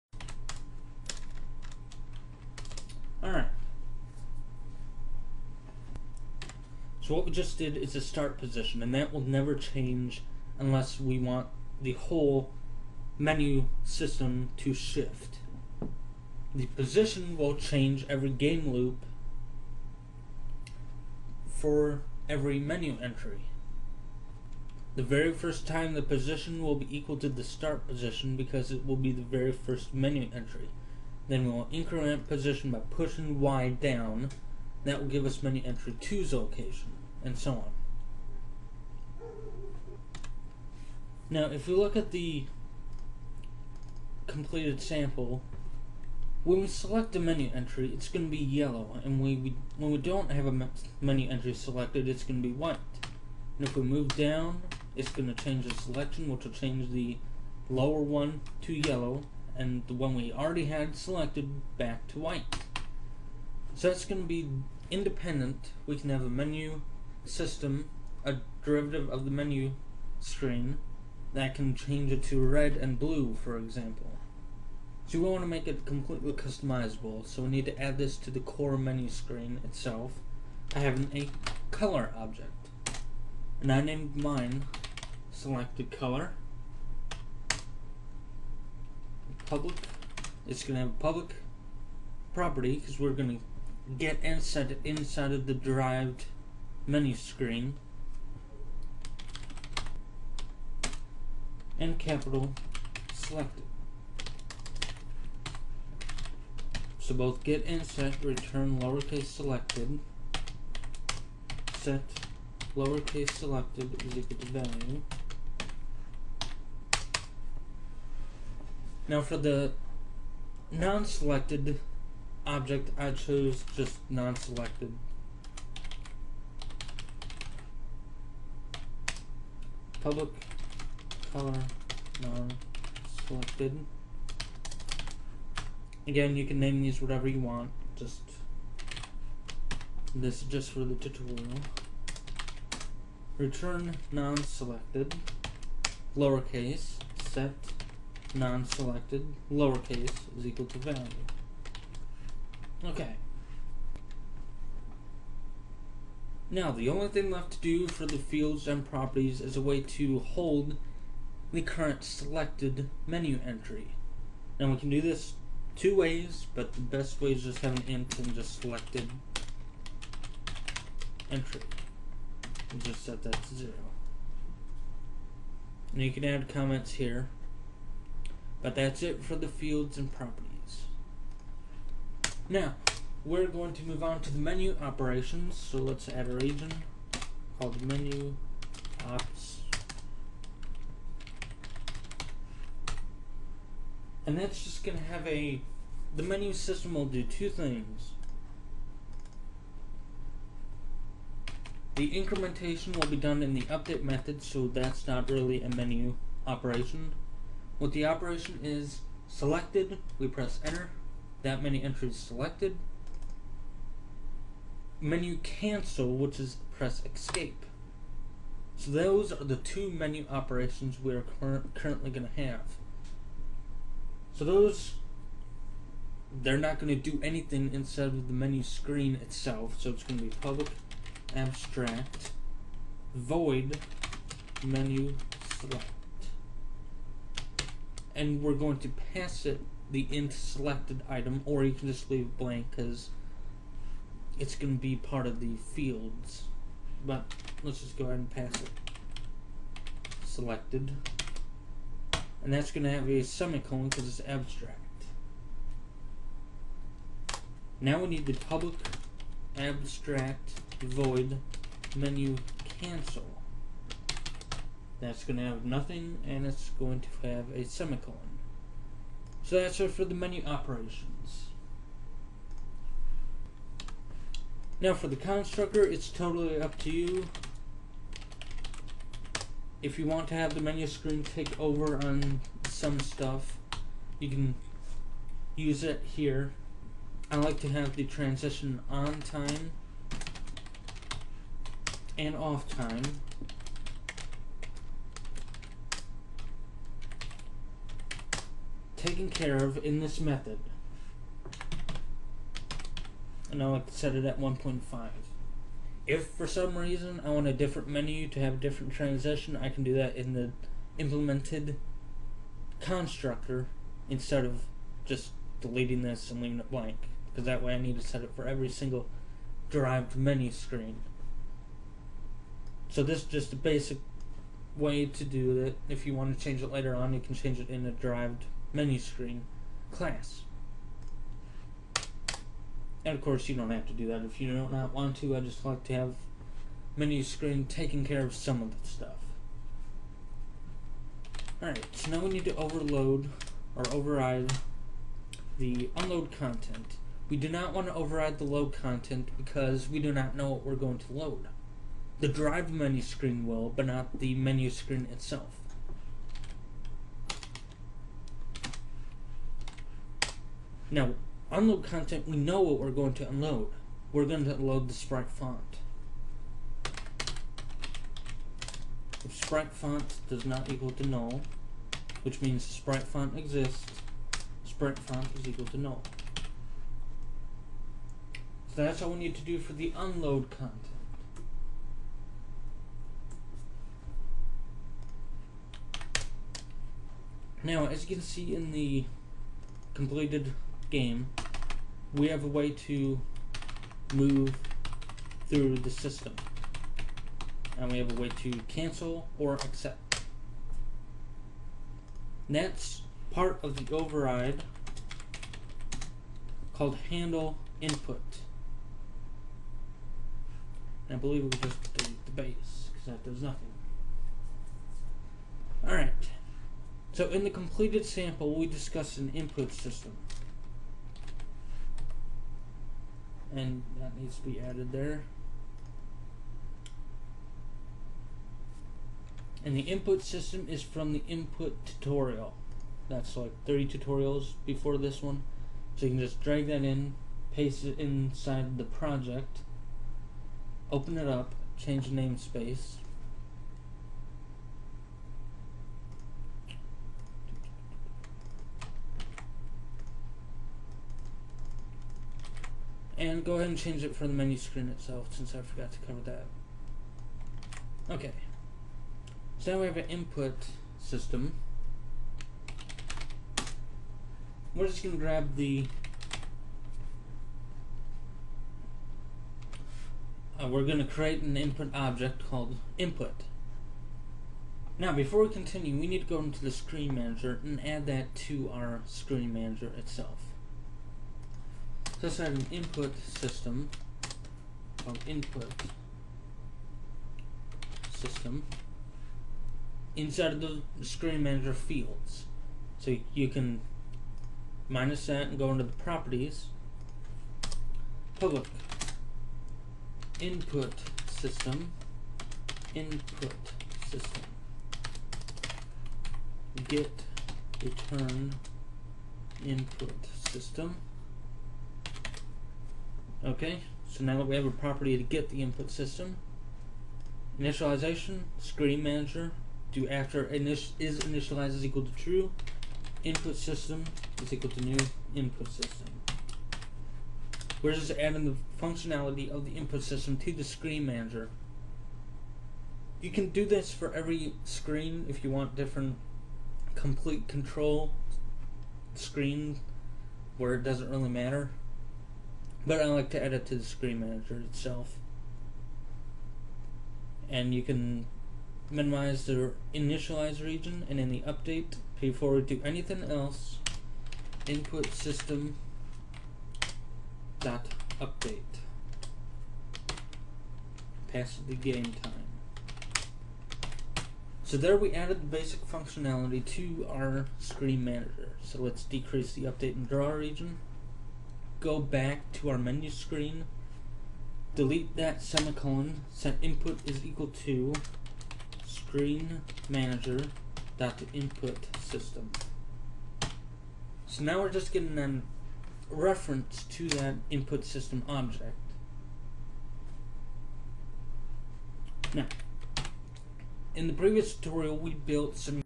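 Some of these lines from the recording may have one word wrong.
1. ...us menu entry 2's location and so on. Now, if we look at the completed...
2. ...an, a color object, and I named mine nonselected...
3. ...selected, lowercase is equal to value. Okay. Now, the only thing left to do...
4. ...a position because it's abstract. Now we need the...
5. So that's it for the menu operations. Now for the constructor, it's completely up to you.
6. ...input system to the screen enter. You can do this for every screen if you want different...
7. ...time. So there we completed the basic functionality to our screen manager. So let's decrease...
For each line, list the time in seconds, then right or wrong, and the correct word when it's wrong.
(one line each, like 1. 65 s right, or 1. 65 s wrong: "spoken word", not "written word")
1. 35 s right
2. 80 s wrong: "selected", not "nonselected"
3. 148 s right
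4. 253 s wrong: "semicolon", not "position"
5. 269 s wrong: "totally", not "completely"
6. 529 s wrong: "manager", not "enter"
7. 562 s wrong: "added", not "completed".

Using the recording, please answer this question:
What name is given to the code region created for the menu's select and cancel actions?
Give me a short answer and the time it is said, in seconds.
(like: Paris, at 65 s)
menu ops, at 187 s.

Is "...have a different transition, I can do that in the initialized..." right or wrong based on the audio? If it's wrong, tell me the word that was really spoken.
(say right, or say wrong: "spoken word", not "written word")
wrong: "implemented", not "initialized".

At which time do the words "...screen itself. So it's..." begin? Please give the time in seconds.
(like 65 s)
228 s.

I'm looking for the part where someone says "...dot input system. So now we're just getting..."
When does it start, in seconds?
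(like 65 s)
580 s.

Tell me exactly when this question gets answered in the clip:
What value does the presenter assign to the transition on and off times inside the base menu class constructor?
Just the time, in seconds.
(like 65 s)
304 s.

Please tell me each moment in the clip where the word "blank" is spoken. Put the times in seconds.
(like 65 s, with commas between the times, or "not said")
242 s, 316 s.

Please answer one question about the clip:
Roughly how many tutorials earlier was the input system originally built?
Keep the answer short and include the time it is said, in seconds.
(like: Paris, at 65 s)
30, at 433 s.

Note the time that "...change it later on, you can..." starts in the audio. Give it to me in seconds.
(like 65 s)
326 s.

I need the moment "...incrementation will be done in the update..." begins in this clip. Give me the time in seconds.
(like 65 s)
202 s.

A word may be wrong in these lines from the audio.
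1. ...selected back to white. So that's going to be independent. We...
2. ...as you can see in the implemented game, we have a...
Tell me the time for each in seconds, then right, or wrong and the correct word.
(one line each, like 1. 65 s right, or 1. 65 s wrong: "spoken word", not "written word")
1. 60 s right
2. 387 s wrong: "completed", not "implemented".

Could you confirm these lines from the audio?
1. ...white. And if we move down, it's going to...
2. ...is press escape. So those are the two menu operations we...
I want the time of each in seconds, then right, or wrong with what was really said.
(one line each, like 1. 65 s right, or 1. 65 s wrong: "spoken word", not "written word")
1. 52 s right
2. 216 s right.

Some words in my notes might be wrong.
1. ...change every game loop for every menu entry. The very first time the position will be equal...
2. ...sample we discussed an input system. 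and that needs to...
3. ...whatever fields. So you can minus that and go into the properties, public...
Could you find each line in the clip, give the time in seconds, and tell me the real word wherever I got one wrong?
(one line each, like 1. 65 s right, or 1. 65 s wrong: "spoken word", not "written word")
1. 17 s right
2. 418 s right
3. 491 s wrong: "manager", not "whatever".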